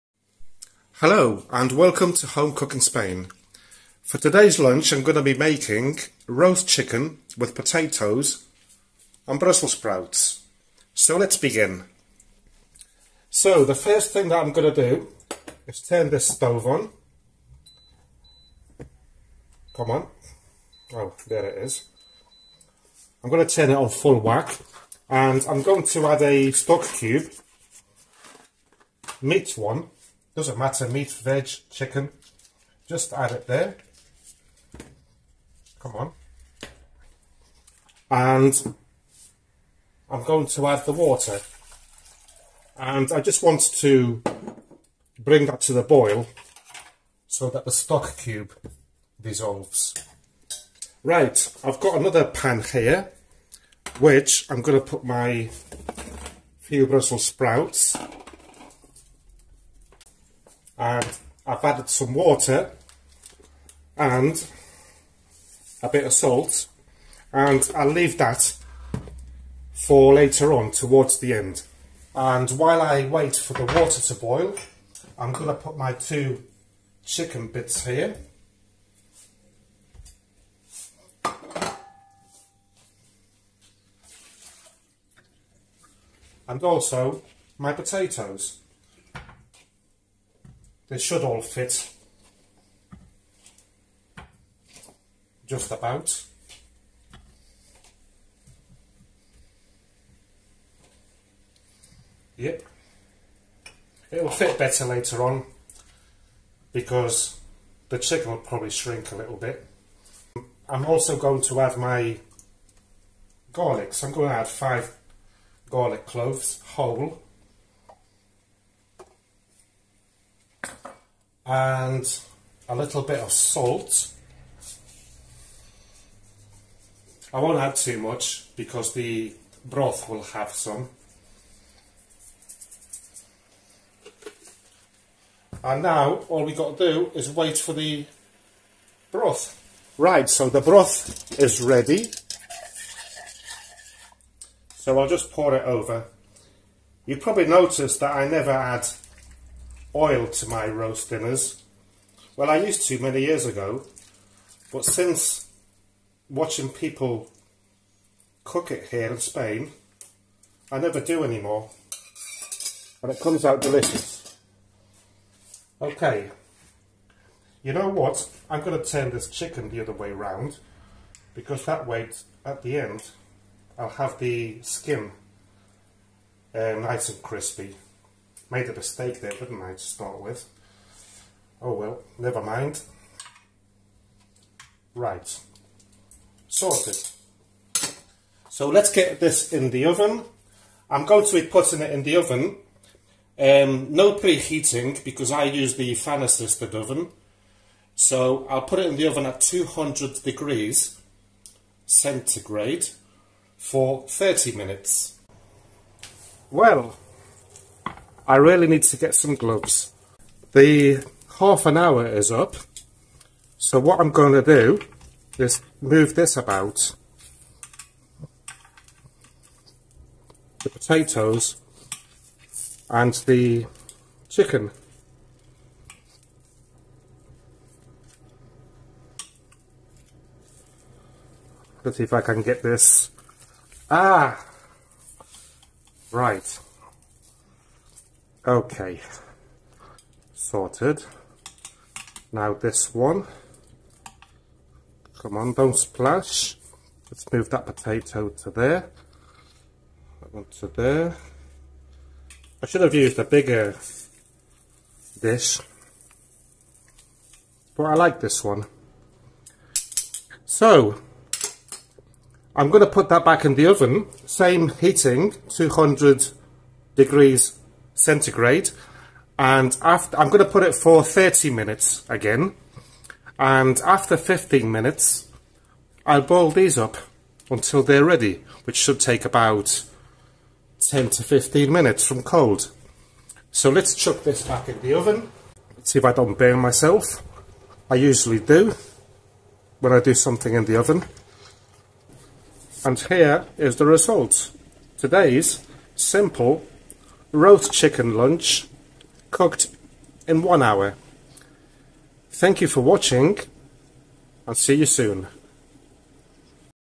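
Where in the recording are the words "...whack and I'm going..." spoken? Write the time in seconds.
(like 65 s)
24 s.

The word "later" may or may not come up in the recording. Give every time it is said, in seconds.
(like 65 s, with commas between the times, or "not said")
70 s, 104 s.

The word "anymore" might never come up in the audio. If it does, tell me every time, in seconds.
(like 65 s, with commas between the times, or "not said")
161 s.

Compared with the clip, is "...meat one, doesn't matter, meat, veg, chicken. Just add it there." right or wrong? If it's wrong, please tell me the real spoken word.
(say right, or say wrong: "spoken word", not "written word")
right.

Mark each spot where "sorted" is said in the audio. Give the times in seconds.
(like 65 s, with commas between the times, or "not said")
186 s, 240 s.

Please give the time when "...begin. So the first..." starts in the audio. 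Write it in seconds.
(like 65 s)
11 s.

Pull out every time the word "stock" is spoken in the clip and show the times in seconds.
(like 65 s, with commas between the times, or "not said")
26 s, 47 s.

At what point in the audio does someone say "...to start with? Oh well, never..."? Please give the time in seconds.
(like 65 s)
179 s.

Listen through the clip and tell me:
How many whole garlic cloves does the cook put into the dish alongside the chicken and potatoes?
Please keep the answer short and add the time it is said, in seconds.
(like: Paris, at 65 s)
5, at 114 s.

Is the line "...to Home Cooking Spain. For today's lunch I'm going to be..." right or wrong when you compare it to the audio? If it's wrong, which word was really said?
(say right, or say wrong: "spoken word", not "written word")
right.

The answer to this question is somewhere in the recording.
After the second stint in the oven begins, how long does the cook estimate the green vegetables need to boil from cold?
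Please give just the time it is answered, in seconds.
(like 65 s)
280 s.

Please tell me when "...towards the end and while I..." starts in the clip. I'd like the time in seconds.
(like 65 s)
70 s.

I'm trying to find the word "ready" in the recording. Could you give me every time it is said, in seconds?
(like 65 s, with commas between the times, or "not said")
141 s, 278 s.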